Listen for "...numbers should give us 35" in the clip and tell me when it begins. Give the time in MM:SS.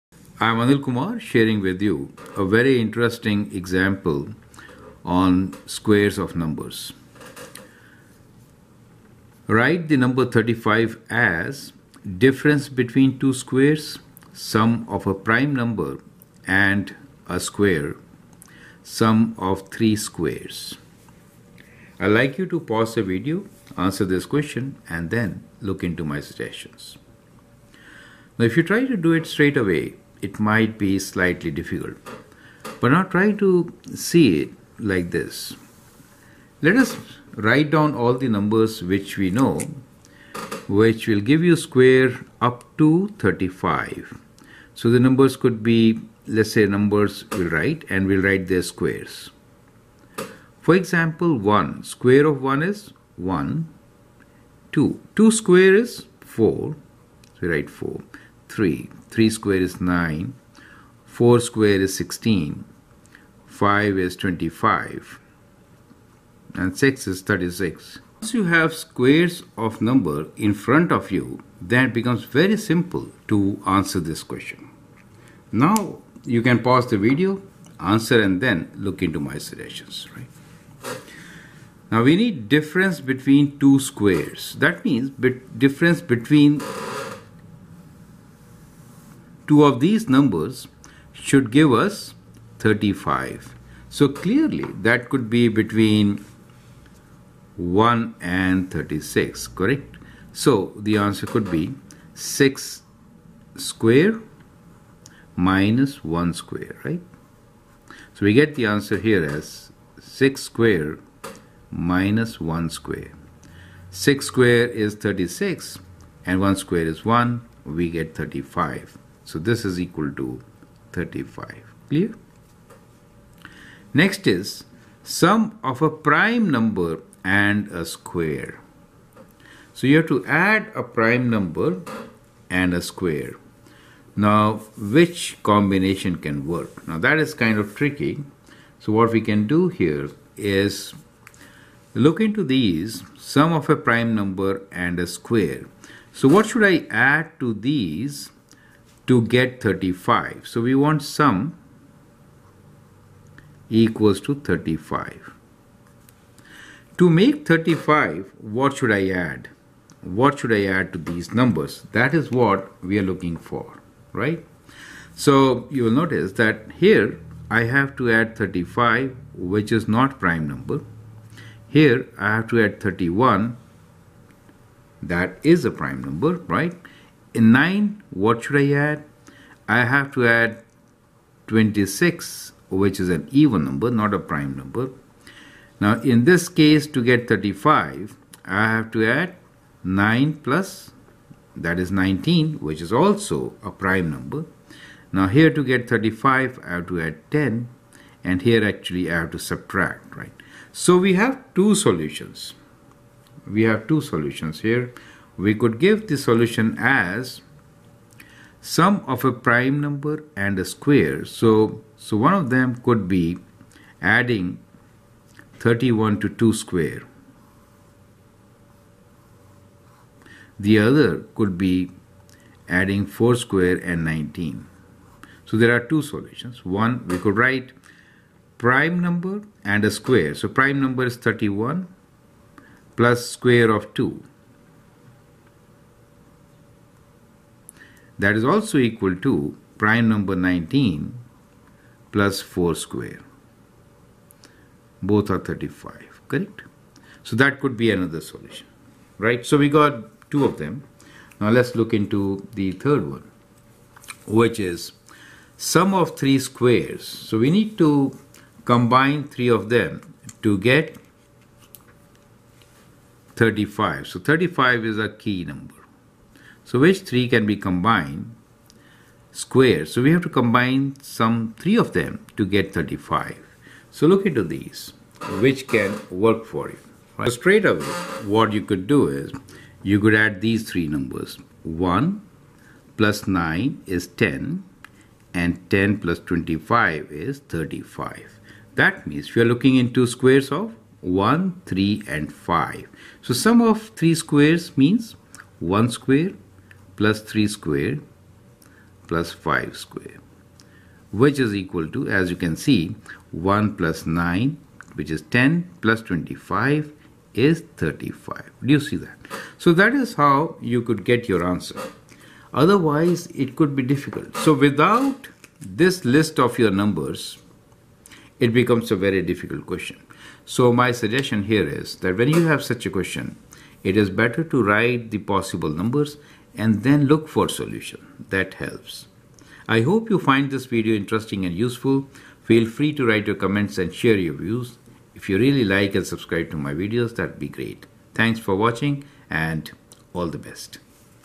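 01:30.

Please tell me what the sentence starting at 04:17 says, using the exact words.
So we need to combine three of them to get 35.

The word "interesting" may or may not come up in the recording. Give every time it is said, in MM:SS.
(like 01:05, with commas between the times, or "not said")
00:02, 05:30.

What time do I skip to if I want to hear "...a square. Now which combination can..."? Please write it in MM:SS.
02:12.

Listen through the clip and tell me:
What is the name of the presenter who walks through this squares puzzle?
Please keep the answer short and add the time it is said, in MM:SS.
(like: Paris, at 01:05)
Anil Kumar, at 00:00.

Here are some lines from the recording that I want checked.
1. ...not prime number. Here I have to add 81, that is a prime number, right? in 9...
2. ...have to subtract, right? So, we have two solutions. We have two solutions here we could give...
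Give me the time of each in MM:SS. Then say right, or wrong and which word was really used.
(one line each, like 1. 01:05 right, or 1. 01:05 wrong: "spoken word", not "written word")
1. 02:49 wrong: "31", not "81"
2. 03:19 right.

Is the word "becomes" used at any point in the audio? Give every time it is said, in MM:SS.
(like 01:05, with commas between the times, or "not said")
01:11, 05:18.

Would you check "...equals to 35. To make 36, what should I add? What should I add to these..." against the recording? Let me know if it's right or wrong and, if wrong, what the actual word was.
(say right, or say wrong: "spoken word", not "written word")
wrong: "35", not "36".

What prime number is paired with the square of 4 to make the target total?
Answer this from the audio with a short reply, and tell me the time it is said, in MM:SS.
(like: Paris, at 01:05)
19, at 03:11.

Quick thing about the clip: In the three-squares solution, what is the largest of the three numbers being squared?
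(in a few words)
5.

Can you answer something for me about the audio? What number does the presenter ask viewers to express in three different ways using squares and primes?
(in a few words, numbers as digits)
35.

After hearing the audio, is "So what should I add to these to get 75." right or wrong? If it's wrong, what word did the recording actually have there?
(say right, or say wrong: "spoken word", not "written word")
wrong: "35", not "75".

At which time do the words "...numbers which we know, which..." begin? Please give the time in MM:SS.
00:38.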